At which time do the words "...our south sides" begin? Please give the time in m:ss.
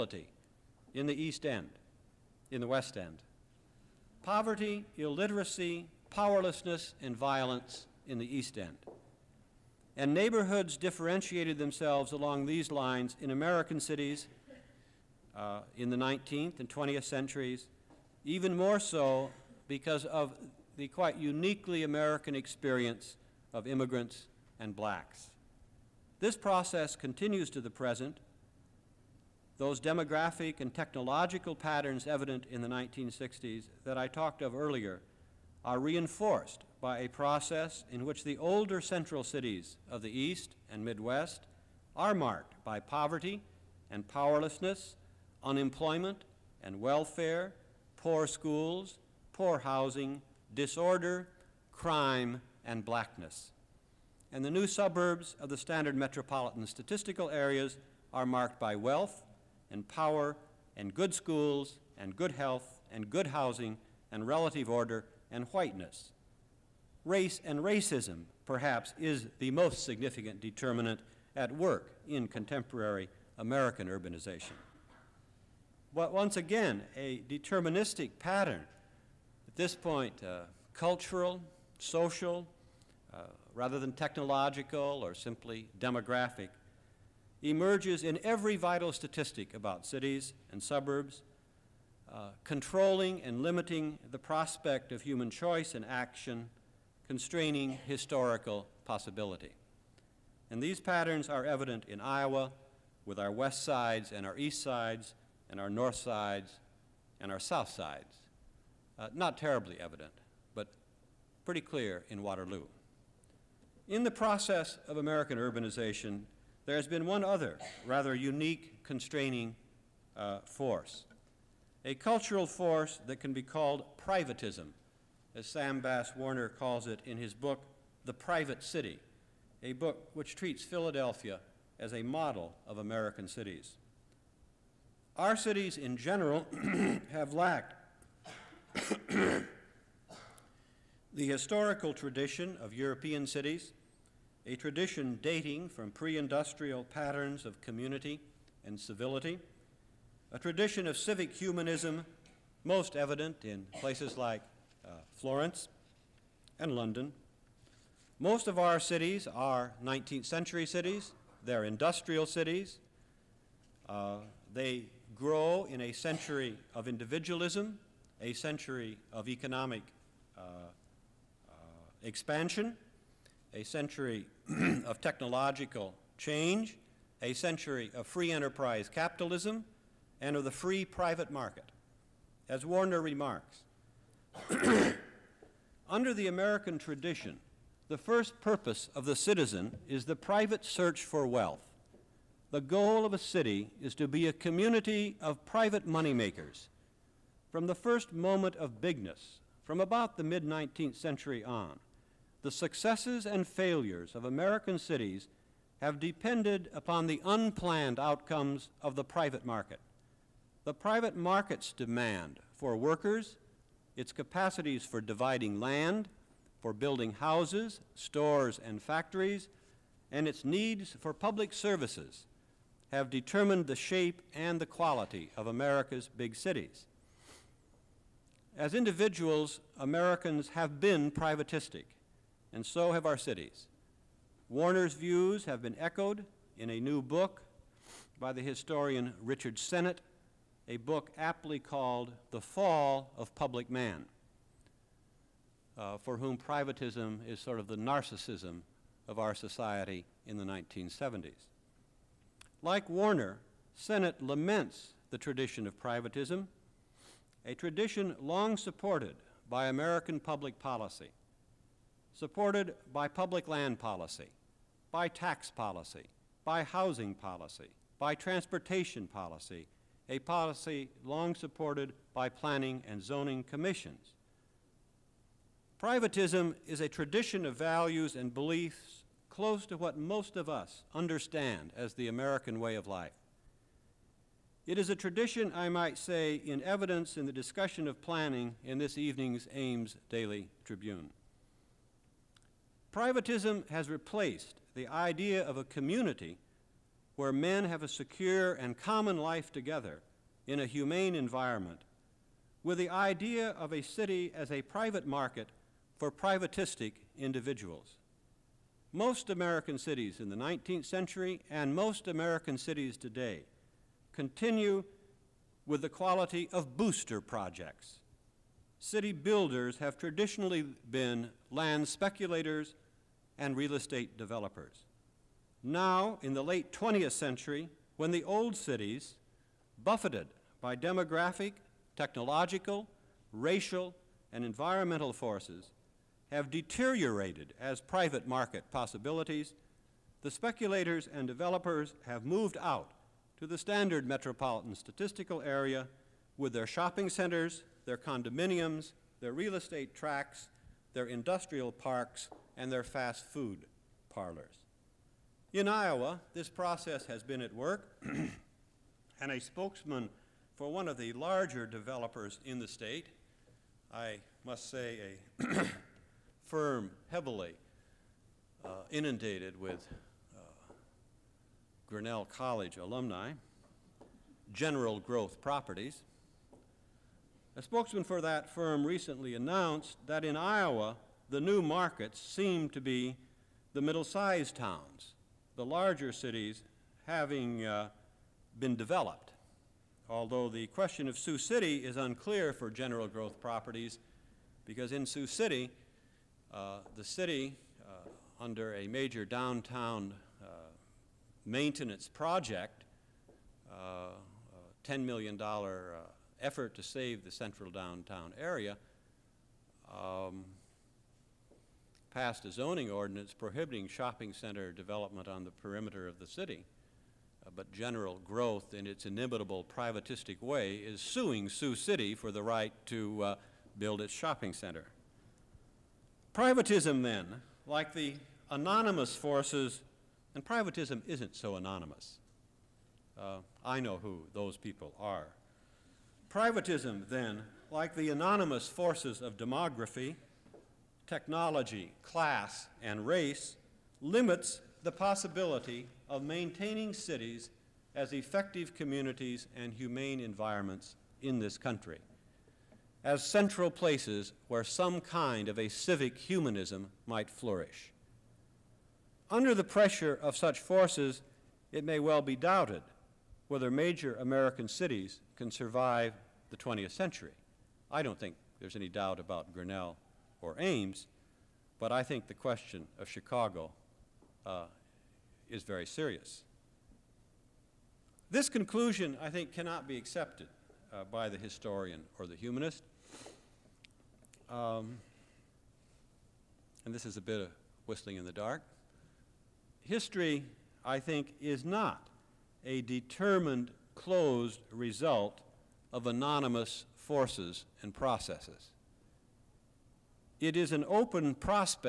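1:47.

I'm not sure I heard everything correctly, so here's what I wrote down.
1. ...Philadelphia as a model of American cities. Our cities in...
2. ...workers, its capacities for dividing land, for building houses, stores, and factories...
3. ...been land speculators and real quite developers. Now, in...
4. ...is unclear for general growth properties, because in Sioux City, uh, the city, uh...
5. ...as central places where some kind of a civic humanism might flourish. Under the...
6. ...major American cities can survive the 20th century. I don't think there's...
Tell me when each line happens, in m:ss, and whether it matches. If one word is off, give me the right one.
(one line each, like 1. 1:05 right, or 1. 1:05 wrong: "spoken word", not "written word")
1. 2:10 right
2. 3:32 right
3. 5:20 wrong: "estate", not "quite"
4. 6:31 right
5. 7:33 right
6. 7:43 right.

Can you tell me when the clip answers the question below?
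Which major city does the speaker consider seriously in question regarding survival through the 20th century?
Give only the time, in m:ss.
7:53.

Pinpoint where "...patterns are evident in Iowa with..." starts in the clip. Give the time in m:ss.
1:40.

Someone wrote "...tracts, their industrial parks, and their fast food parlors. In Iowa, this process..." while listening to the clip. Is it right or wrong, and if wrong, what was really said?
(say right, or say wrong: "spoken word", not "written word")
right.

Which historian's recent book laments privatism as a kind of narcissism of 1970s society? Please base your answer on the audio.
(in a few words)
Richard Sennett.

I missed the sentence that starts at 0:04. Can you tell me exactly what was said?
Poverty, illiteracy, powerlessness, and violence in the East End.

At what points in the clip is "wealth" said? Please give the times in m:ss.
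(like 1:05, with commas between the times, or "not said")
0:58, 3:11.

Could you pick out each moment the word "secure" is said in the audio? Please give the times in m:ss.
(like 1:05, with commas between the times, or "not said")
4:57.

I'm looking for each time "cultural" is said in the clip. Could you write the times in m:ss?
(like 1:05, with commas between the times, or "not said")
1:20, 2:01.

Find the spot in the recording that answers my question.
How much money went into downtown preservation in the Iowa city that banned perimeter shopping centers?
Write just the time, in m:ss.
6:44.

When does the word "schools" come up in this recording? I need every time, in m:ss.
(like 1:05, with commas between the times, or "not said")
0:48, 1:01.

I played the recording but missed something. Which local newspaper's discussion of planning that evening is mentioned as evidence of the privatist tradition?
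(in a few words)
Ames Daily Tribune.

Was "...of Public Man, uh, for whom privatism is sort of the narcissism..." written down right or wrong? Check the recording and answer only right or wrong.
right.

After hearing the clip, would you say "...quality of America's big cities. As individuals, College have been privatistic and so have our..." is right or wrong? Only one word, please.
wrong.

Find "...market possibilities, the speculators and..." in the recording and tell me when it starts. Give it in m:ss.
5:38.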